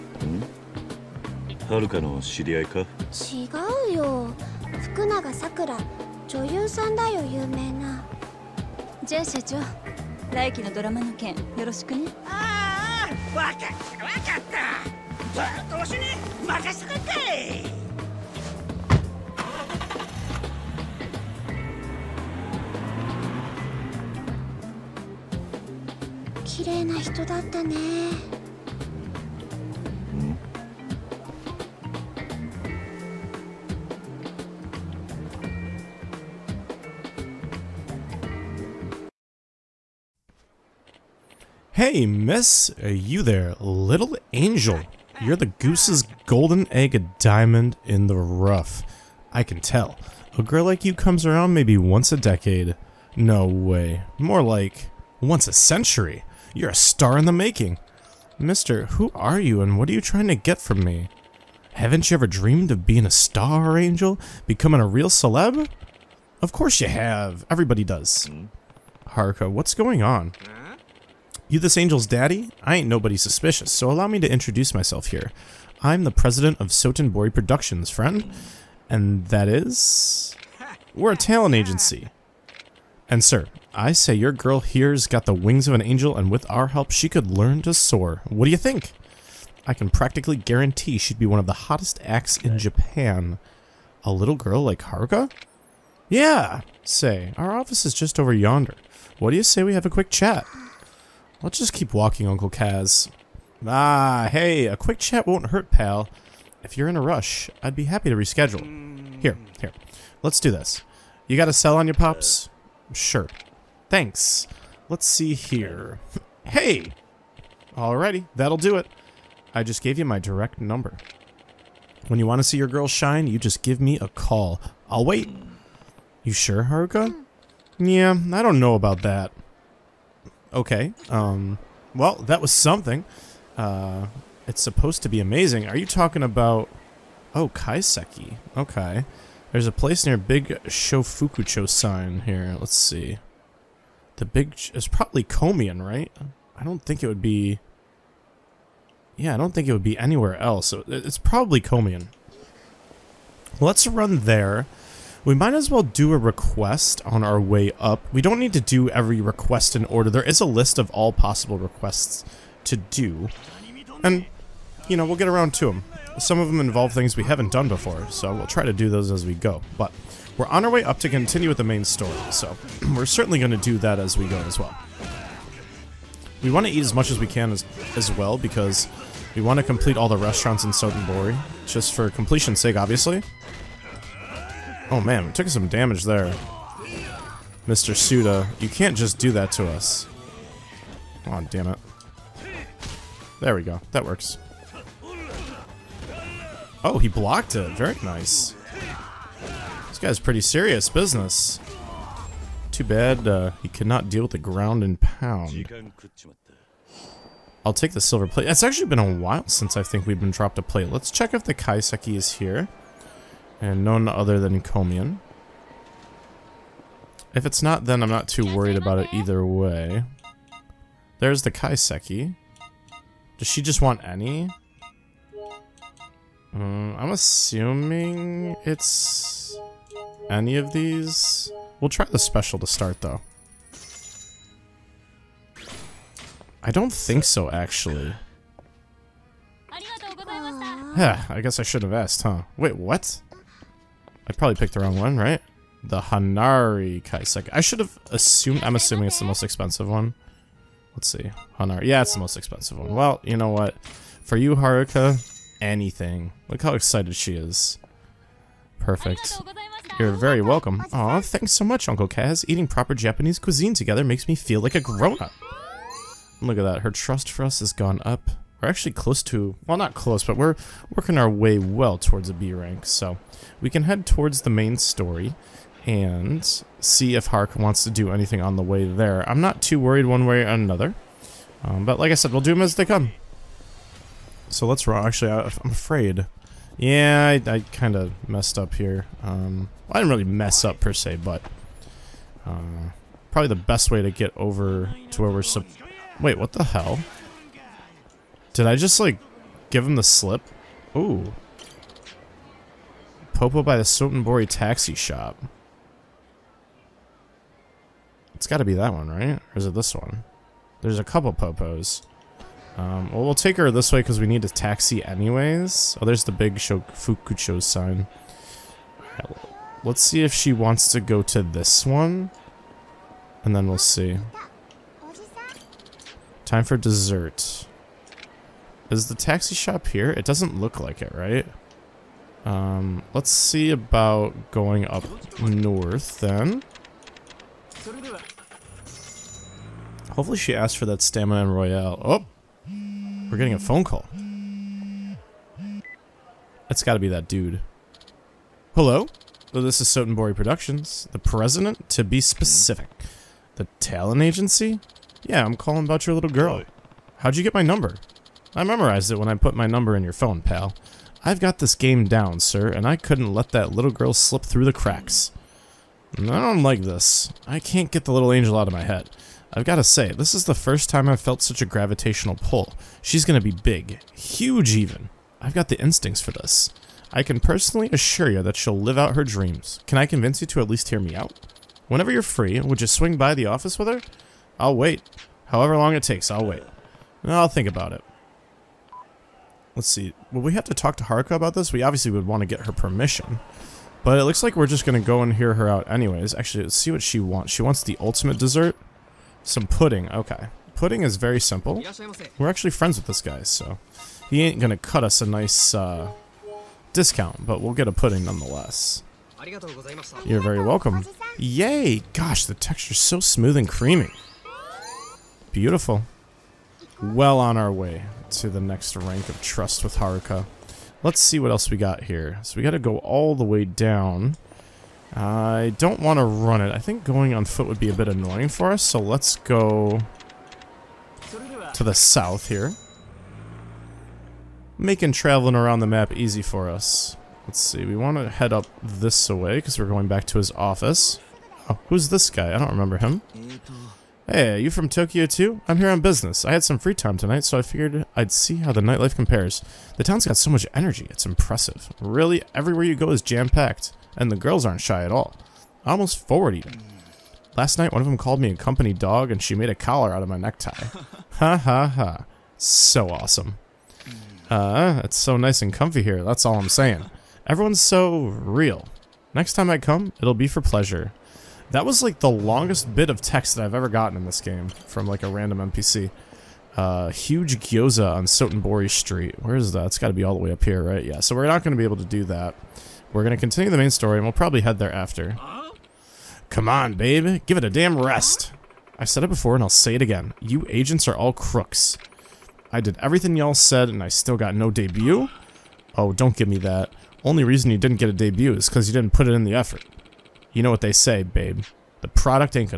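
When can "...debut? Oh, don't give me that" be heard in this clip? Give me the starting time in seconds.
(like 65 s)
494 s.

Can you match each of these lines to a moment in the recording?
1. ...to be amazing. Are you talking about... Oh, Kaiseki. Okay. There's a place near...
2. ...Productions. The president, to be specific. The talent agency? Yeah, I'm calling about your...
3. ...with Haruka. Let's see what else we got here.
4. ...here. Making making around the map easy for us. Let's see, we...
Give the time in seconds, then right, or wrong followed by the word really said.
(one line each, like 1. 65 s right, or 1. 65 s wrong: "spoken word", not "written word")
1. 135 s right
2. 350 s right
3. 419 s right
4. 432 s wrong: "traveling", not "making".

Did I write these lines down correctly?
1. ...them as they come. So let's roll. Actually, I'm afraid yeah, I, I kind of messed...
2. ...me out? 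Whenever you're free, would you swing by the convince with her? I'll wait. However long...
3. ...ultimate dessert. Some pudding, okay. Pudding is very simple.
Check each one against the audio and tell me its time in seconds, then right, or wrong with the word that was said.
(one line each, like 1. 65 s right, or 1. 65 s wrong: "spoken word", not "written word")
1. 282 s right
2. 380 s wrong: "office", not "convince"
3. 397 s right.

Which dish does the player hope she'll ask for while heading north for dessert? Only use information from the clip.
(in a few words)
Staminan Royale.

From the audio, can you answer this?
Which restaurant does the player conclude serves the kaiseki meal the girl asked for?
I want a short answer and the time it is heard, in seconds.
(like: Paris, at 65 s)
Komian, at 214 s.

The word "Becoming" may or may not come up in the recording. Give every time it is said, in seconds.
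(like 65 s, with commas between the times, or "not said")
64 s.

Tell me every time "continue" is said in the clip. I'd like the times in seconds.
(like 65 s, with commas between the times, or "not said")
171 s, 483 s.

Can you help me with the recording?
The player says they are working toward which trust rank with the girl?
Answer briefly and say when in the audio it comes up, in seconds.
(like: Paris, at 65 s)
B rank, at 272 s.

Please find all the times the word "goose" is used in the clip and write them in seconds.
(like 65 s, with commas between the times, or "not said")
45 s.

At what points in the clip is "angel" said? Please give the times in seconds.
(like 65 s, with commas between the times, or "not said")
44 s, 63 s, 71 s, 85 s, 368 s.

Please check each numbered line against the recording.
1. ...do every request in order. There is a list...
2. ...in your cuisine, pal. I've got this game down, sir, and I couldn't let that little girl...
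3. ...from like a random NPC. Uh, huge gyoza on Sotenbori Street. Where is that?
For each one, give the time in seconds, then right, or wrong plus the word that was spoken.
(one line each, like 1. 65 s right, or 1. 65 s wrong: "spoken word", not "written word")
1. 158 s right
2. 359 s wrong: "phone", not "cuisine"
3. 474 s right.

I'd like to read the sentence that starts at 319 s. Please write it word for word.
let's see if she wants to go to this one.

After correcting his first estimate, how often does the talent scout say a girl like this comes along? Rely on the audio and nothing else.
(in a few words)
once a century.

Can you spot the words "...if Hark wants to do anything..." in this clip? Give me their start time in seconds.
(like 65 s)
277 s.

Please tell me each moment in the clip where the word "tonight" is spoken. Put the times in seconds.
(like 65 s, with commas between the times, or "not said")
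447 s.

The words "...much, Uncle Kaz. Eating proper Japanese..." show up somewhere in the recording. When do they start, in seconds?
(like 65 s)
261 s.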